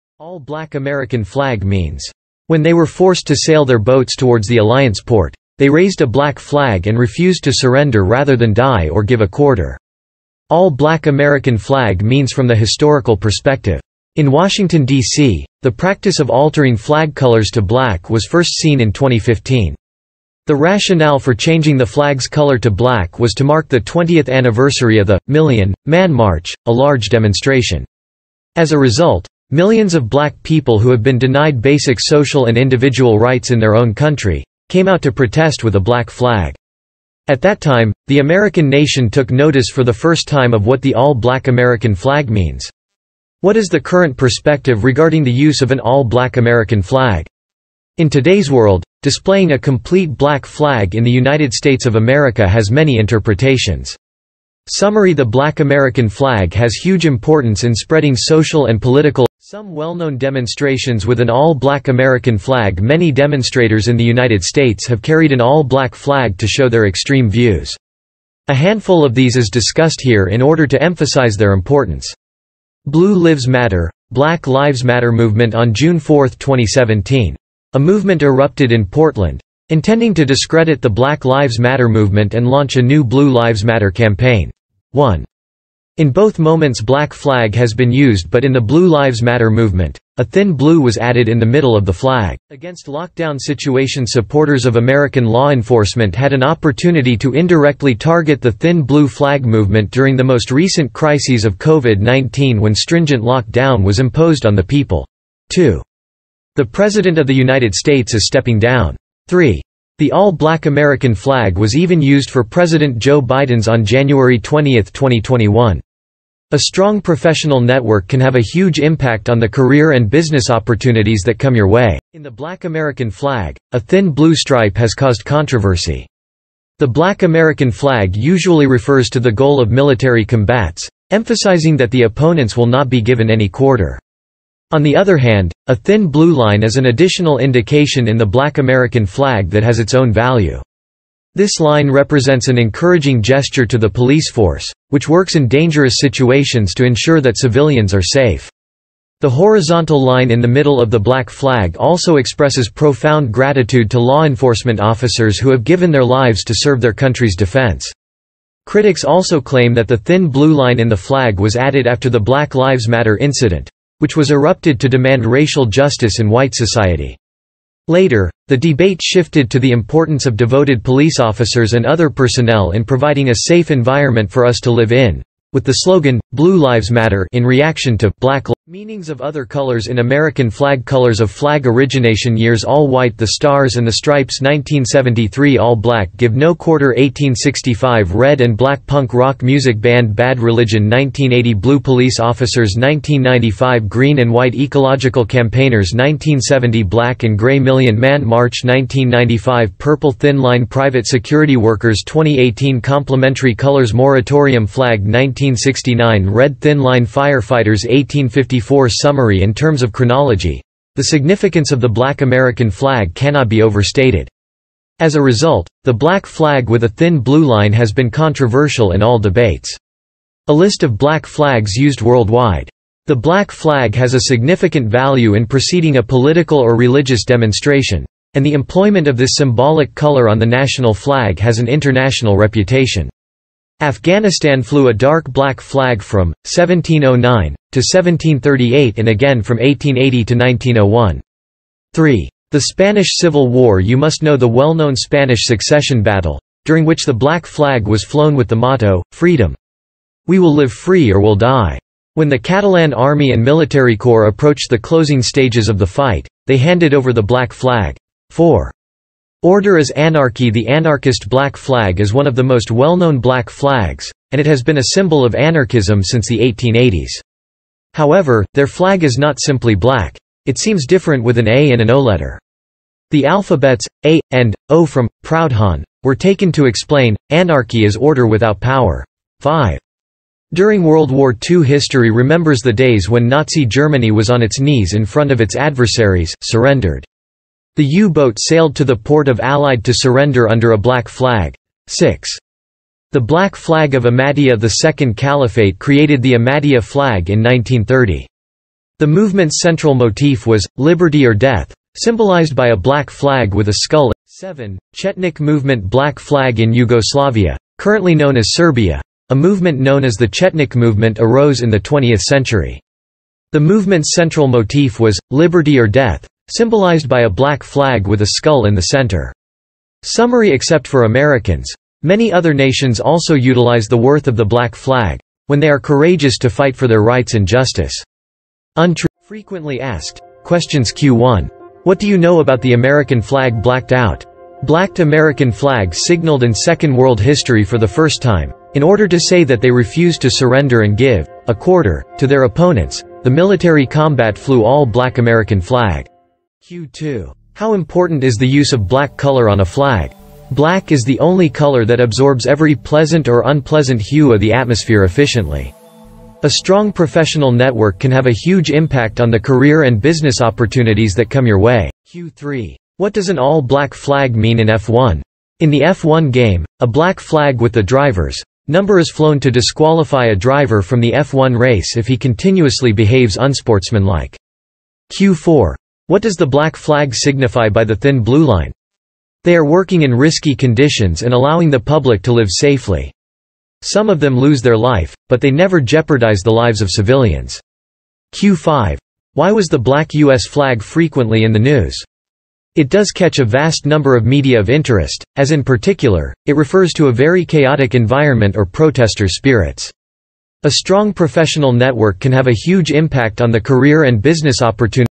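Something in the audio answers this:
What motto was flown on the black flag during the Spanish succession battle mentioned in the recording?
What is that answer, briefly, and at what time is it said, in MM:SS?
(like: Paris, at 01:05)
Freedom, at 04:09.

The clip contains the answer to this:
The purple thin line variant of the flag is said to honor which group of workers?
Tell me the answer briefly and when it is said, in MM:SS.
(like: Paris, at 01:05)
private security workers, at 03:20.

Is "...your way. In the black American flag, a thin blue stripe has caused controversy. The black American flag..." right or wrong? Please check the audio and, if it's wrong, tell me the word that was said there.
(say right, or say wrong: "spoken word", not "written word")
right.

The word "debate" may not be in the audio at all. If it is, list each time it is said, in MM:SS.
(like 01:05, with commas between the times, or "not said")
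02:48, 03:39.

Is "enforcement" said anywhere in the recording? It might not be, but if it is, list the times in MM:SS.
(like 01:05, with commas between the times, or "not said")
01:35, 02:34.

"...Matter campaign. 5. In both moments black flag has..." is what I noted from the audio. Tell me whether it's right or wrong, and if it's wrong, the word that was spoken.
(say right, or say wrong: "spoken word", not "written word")
wrong: "1", not "5".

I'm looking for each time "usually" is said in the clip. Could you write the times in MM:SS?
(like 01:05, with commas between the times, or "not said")
02:08.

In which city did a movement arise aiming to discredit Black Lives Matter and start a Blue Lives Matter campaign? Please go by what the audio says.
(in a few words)
Portland.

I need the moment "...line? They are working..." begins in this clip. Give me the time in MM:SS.
06:18.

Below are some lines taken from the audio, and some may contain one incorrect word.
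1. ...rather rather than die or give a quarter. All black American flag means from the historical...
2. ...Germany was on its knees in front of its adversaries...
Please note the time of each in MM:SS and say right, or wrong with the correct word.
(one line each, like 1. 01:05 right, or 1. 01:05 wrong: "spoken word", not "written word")
1. 00:07 wrong: "surrender", not "rather"
2. 04:43 right.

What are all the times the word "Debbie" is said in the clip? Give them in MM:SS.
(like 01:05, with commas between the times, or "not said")
not said.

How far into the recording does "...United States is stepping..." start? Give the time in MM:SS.
01:47.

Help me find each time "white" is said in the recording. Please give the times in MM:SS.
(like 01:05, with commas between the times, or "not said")
02:46, 03:02, 03:14.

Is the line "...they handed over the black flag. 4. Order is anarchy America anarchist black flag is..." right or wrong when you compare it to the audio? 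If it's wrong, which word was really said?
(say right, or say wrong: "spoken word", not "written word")
wrong: "The", not "America".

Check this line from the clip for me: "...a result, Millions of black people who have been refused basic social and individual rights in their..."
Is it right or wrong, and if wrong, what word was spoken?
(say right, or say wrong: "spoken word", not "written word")
wrong: "denied", not "refused".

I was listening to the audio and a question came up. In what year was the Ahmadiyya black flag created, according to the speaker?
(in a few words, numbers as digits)
1930.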